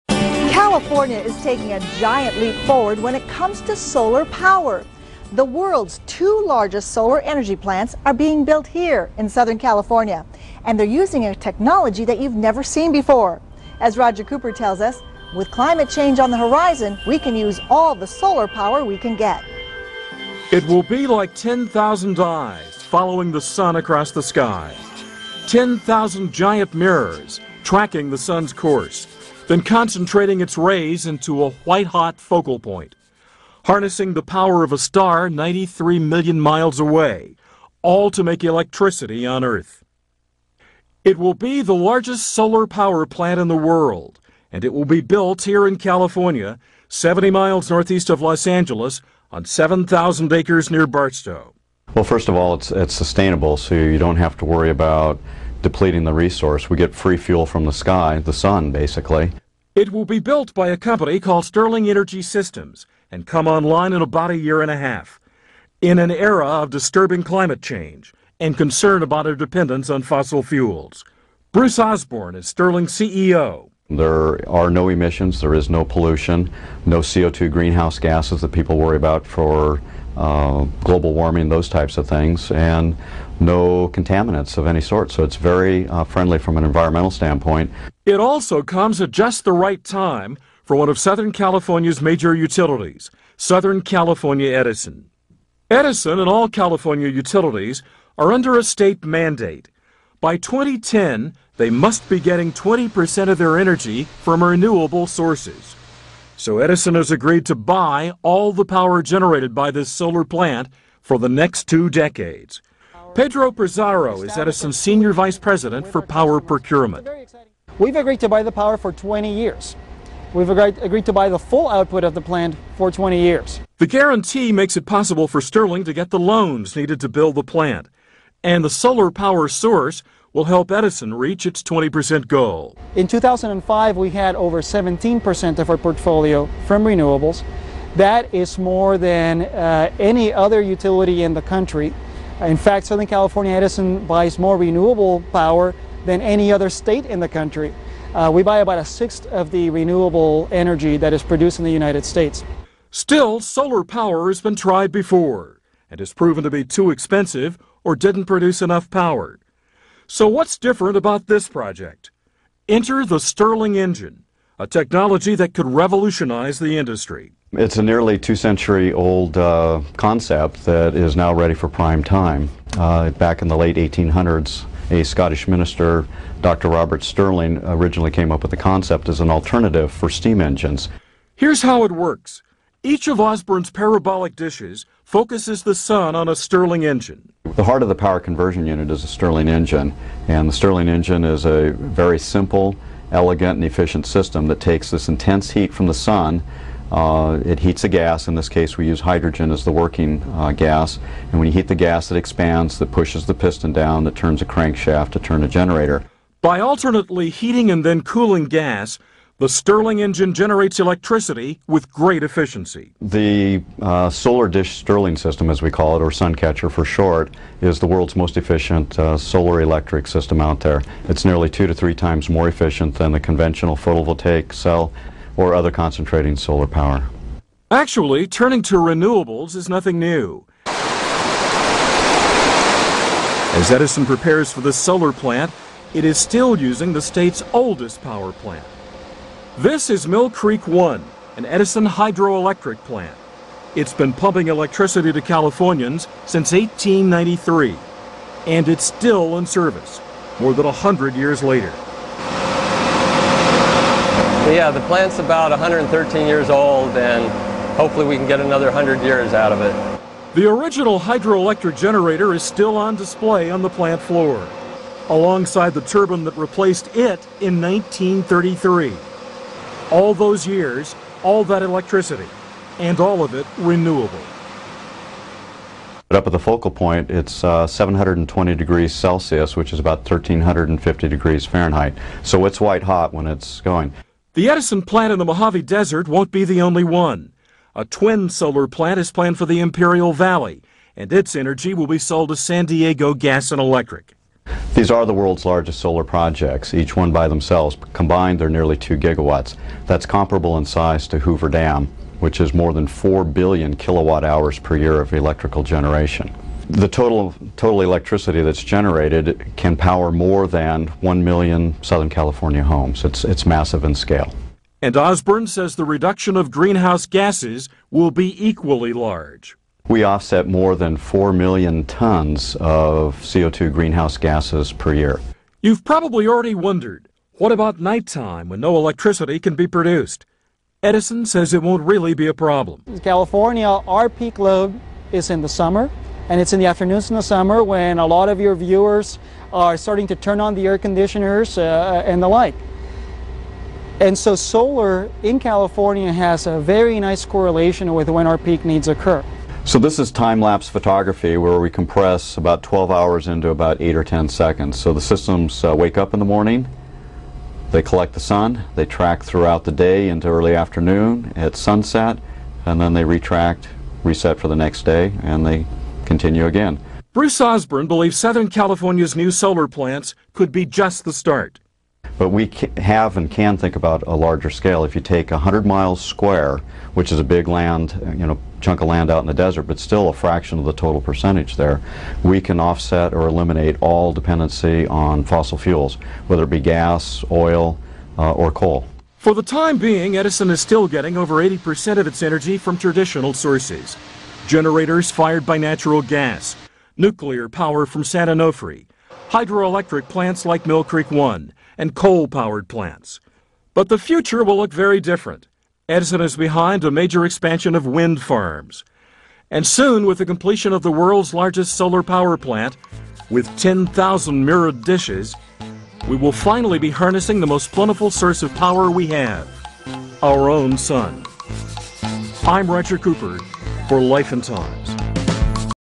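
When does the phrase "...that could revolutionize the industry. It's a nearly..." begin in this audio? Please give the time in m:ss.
2:45.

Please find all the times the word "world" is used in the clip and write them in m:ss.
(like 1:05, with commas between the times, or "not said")
0:05, 0:43, 3:37, 4:55, 6:50.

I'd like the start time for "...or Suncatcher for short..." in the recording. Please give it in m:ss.
3:36.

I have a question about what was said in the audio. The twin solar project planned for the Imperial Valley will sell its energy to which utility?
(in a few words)
San Diego Gas and Electric.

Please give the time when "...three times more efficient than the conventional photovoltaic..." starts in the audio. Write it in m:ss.
3:41.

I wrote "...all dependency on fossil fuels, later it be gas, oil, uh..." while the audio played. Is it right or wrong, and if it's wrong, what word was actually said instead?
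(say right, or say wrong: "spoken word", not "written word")
wrong: "whether", not "later".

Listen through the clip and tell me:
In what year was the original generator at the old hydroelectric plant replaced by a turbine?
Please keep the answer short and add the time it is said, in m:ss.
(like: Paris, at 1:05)
1933, at 4:27.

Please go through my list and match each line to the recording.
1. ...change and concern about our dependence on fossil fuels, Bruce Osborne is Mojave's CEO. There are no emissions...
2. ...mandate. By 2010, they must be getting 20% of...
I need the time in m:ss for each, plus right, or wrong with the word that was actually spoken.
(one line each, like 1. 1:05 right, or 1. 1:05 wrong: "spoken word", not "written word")
1. 1:07 wrong: "Stirling", not "Mojave"
2. 1:39 right.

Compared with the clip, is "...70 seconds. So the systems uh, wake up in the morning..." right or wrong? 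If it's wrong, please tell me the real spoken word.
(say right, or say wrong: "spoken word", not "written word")
wrong: "10", not "70".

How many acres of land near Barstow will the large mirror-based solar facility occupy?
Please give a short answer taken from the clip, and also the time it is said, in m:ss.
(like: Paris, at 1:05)
7,000 acres, at 0:49.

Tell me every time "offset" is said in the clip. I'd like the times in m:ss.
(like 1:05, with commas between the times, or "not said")
5:20, 6:22.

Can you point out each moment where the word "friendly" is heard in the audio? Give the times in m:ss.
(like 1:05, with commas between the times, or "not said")
1:26.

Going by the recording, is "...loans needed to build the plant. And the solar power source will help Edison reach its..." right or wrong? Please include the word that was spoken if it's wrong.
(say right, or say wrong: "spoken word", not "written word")
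right.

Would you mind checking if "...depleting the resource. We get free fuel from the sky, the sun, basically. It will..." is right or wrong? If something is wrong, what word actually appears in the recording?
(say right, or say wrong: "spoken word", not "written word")
right.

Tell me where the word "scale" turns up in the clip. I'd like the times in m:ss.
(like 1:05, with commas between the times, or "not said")
5:13, 6:14.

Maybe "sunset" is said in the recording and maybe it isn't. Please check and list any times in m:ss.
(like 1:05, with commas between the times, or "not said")
6:01.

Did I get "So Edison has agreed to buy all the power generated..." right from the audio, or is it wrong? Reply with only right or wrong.
right.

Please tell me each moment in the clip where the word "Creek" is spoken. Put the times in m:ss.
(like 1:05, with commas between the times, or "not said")
4:00, 6:40.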